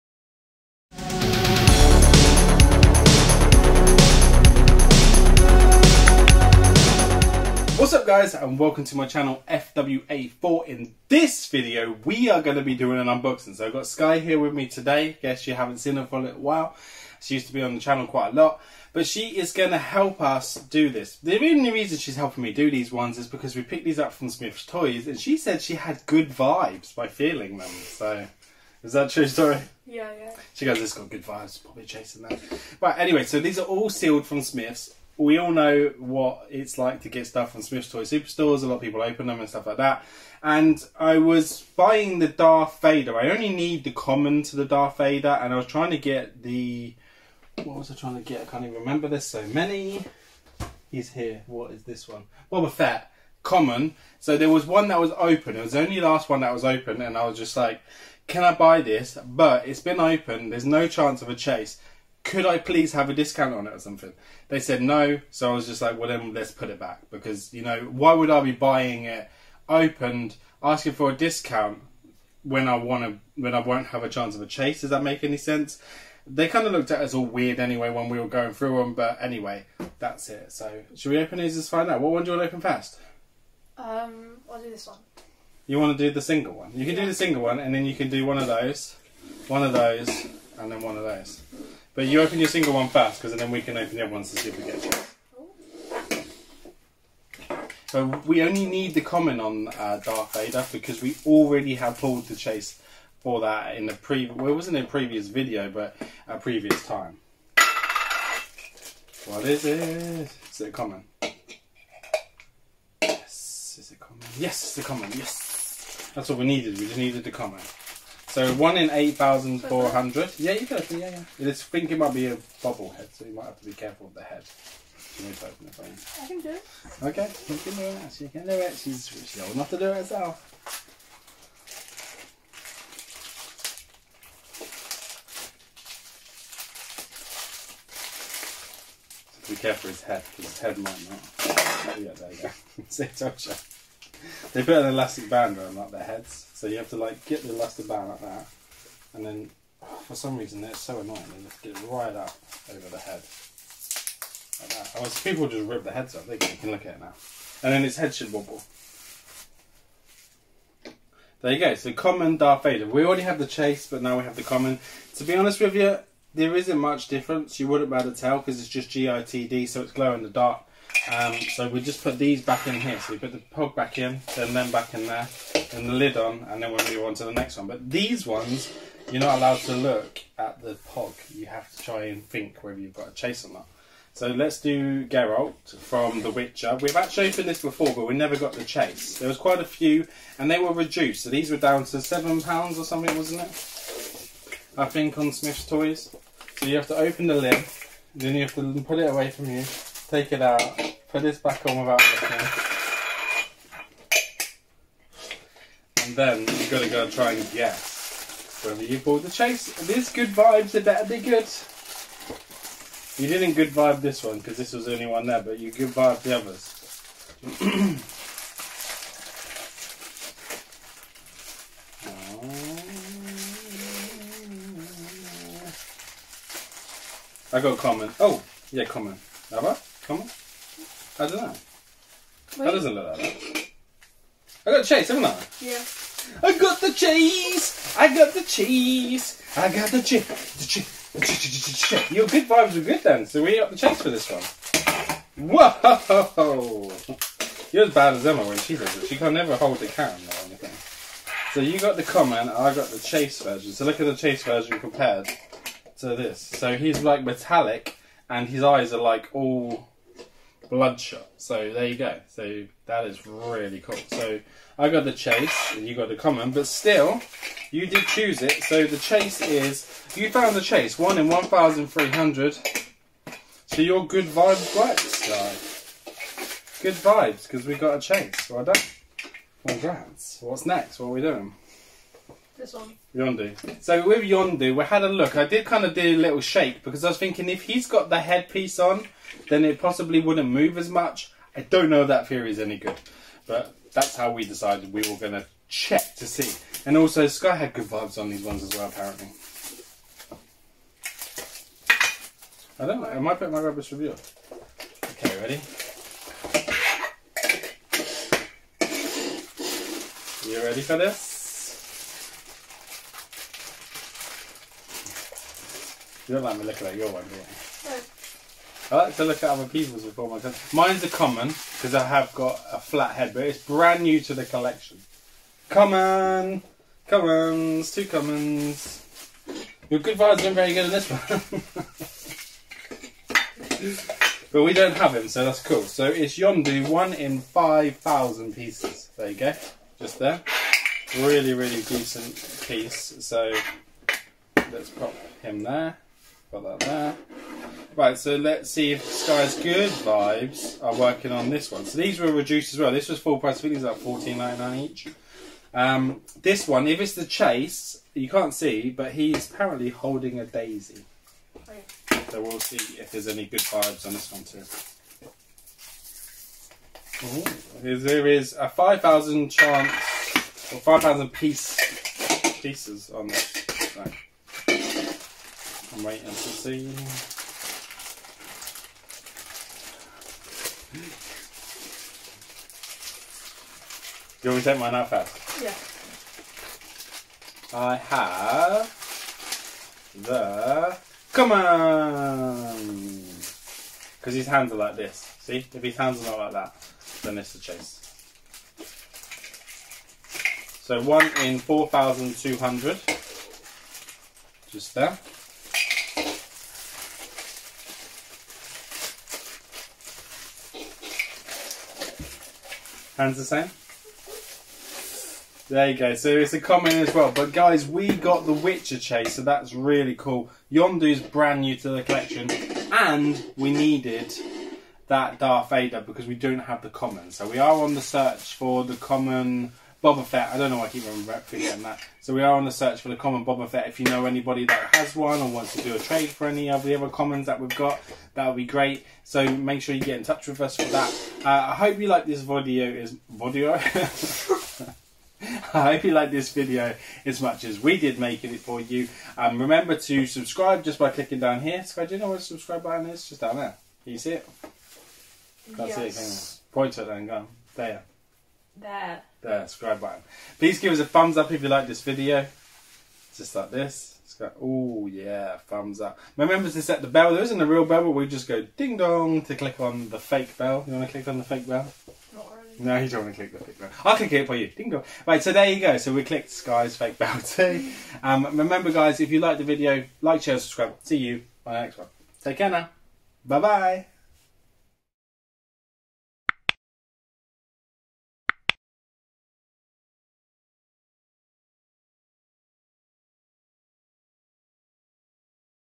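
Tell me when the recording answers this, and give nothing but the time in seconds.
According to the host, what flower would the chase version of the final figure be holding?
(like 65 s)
360 s.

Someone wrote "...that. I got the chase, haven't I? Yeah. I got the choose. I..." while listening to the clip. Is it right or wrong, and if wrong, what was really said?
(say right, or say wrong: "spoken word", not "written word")
wrong: "cheese", not "choose".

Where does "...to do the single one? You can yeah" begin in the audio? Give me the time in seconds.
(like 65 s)
85 s.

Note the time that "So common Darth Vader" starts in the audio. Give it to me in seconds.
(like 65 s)
161 s.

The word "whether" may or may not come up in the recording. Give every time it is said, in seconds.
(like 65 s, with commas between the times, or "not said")
182 s, 208 s.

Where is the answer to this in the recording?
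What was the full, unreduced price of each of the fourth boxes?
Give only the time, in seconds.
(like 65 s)
353 s.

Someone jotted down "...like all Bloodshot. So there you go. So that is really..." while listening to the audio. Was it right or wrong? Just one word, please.
right.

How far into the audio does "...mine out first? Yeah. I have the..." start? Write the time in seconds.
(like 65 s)
384 s.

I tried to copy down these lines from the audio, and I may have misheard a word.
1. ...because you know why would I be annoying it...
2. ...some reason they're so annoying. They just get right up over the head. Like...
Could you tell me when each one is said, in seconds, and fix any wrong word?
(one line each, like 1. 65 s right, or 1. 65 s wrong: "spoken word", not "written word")
1. 67 s wrong: "buying", not "annoying"
2. 150 s right.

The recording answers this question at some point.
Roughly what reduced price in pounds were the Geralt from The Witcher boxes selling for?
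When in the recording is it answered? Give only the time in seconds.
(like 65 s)
191 s.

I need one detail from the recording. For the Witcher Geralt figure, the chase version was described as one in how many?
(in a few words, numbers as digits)
1,300.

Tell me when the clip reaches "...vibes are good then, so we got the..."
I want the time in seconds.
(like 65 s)
242 s.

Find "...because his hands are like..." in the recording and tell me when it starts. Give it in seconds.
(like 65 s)
394 s.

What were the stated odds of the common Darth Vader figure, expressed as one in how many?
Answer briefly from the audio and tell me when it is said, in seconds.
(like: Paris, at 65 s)
8,400, at 118 s.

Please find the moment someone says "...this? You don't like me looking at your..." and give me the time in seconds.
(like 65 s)
310 s.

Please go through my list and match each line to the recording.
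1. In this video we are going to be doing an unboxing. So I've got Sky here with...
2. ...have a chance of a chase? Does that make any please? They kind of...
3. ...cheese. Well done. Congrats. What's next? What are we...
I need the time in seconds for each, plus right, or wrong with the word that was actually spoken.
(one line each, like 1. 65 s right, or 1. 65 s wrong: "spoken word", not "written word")
1. 10 s right
2. 73 s wrong: "sense", not "please"
3. 277 s wrong: "chase", not "cheese".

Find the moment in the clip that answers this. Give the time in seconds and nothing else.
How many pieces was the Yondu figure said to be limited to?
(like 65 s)
337 s.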